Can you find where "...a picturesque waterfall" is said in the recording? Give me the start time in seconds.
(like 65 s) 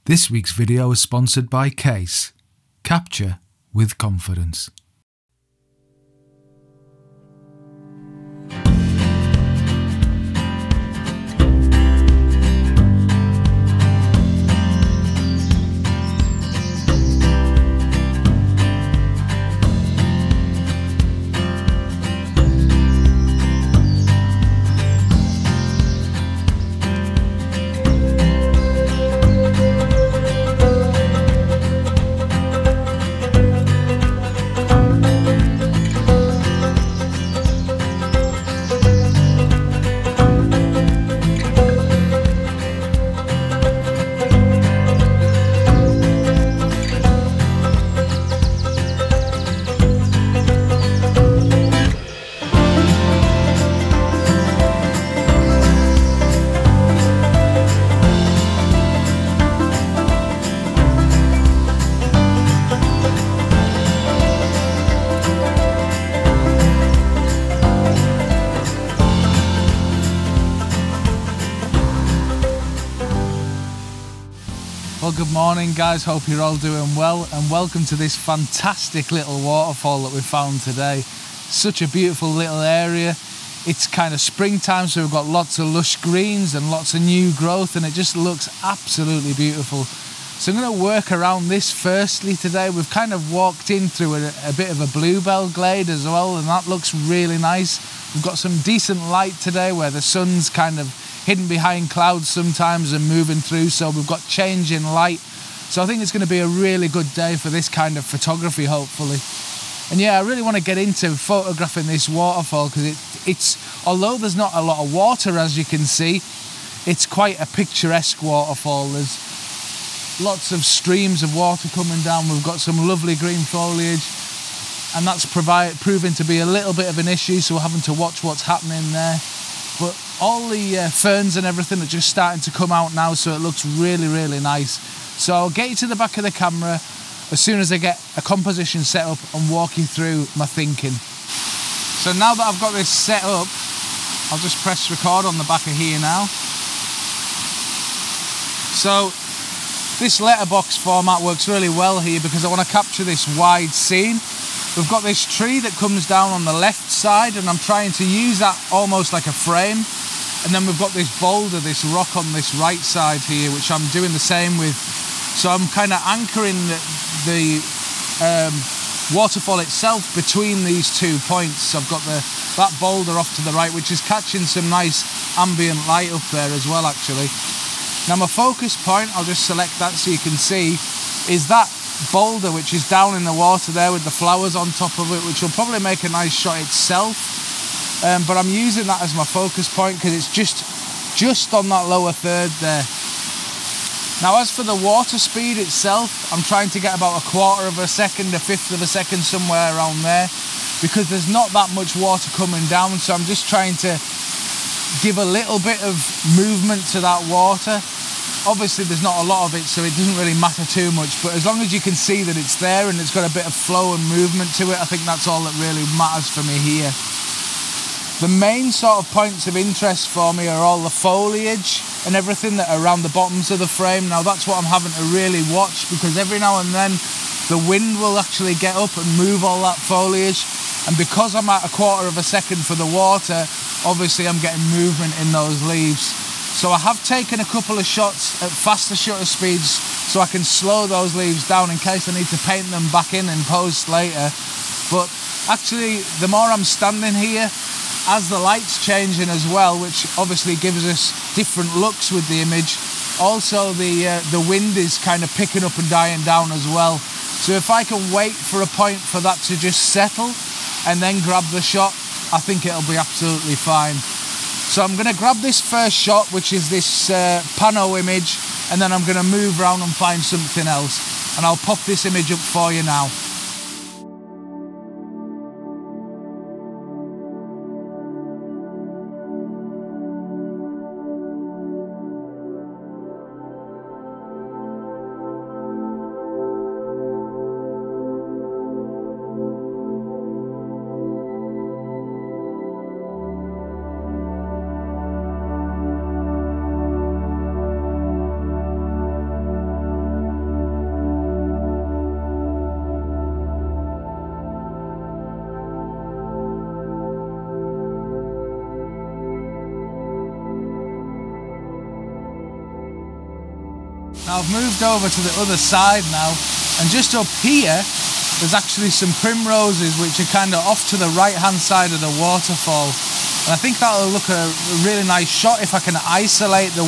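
117 s.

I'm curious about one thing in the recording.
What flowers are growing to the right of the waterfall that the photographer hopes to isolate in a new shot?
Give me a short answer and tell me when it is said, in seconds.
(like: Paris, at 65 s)
primroses, at 319 s.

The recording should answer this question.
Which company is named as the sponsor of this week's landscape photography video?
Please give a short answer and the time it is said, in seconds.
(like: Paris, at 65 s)
Kase, at 1 s.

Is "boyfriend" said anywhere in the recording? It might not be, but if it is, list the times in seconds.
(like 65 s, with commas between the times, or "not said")
not said.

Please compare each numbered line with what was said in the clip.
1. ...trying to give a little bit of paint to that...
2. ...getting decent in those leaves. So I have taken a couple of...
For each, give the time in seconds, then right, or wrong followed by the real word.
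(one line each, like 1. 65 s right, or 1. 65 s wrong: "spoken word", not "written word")
1. 203 s wrong: "movement", not "paint"
2. 234 s wrong: "movement", not "decent".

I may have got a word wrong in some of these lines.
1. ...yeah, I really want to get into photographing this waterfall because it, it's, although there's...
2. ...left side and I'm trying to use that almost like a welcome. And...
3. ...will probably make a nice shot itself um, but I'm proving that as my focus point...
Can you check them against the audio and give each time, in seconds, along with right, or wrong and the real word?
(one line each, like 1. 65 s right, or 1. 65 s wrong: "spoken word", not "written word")
1. 109 s right
2. 156 s wrong: "frame", not "welcome"
3. 185 s wrong: "using", not "proving".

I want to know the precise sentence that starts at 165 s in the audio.
So I'm kind of anchoring the, the um, waterfall itself between these two points.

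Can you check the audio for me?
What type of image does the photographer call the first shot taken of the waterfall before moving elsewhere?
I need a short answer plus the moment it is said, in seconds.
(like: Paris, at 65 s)
pano, at 267 s.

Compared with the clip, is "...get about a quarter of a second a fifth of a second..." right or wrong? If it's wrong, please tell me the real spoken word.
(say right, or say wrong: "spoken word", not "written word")
right.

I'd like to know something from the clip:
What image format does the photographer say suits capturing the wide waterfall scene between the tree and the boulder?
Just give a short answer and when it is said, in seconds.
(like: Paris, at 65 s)
letterbox, at 150 s.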